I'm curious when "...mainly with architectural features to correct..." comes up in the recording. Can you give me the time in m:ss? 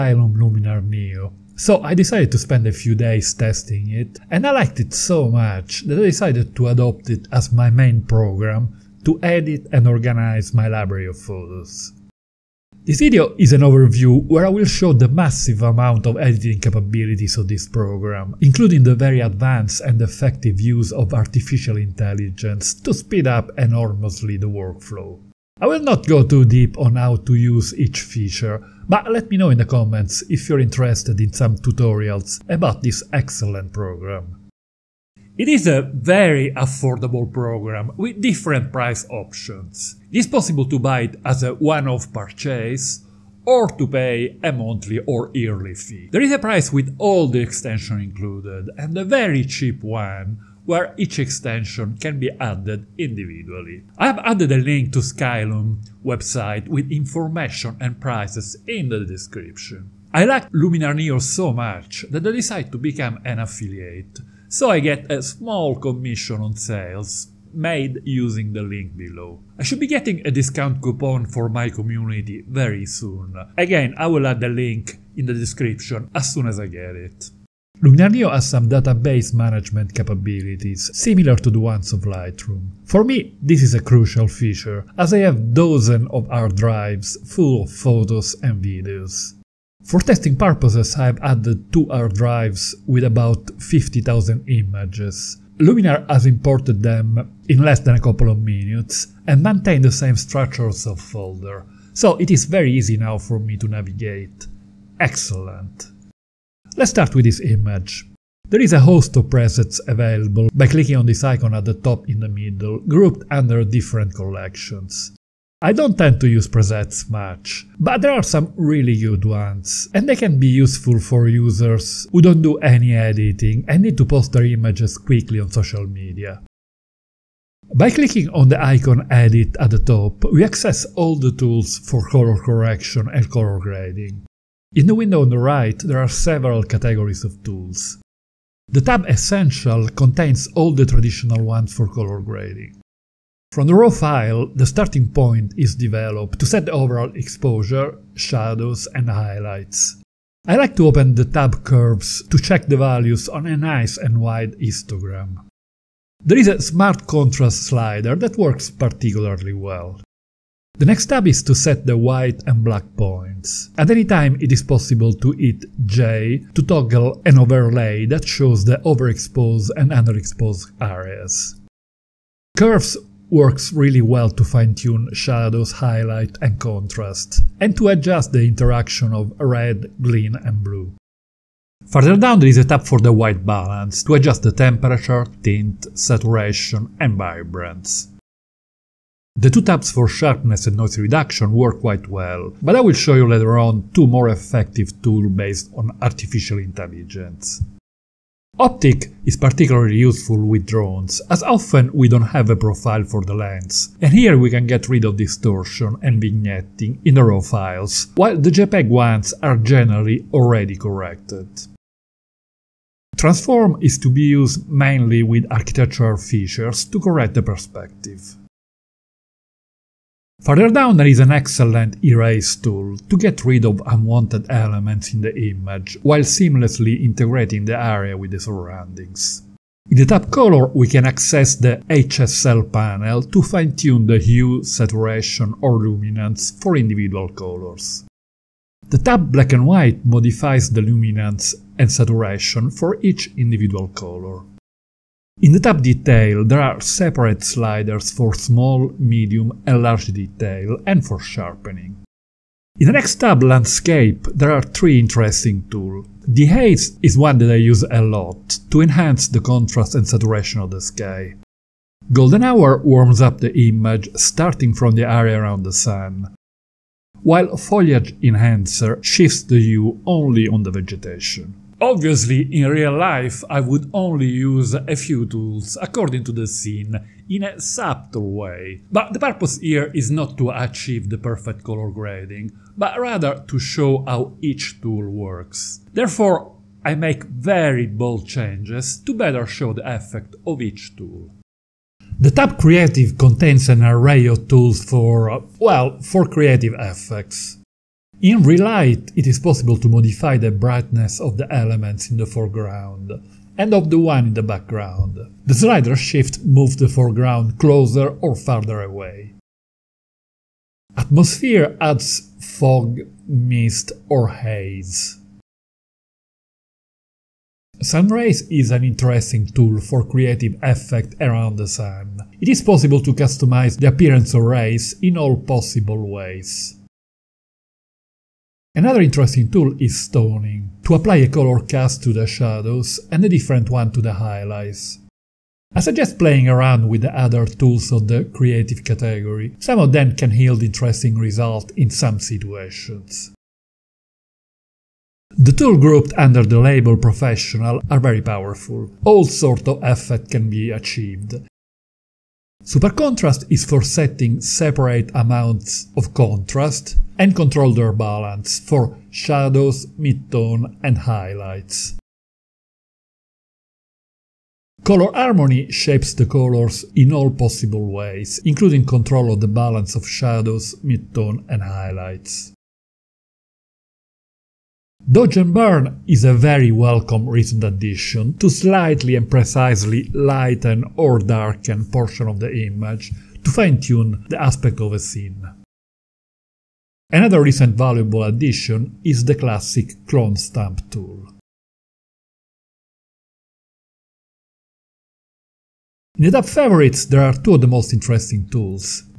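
3:34.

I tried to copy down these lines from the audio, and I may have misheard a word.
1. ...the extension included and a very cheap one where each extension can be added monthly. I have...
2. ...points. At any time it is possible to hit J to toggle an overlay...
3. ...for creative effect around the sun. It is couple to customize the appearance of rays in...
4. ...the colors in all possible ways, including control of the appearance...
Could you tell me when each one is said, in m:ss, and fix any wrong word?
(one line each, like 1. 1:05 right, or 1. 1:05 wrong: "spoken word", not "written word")
1. 0:47 wrong: "individually", not "monthly"
2. 2:42 right
3. 5:19 wrong: "possible", not "couple"
4. 6:06 wrong: "balance", not "appearance".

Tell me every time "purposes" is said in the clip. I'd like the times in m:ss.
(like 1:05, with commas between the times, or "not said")
1:30, 4:39.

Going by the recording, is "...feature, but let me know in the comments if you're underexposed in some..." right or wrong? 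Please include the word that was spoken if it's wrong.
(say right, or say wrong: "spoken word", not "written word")
wrong: "interested", not "underexposed".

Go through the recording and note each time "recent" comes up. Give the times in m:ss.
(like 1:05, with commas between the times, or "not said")
6:17, 6:27.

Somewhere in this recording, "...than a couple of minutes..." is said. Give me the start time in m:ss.
1:37.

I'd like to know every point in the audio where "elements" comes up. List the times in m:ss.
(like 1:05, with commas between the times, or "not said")
3:44, 5:01.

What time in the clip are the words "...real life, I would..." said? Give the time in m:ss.
4:32.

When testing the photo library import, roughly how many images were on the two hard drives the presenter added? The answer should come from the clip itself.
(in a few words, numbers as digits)
50,000.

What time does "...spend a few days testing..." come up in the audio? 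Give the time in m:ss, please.
0:02.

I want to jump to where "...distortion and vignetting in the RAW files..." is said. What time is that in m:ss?
3:25.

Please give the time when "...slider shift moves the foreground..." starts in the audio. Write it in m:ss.
5:05.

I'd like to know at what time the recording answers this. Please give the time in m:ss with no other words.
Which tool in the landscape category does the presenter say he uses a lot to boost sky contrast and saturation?
4:16.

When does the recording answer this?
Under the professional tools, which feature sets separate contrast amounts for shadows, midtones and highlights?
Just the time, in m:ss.
5:52.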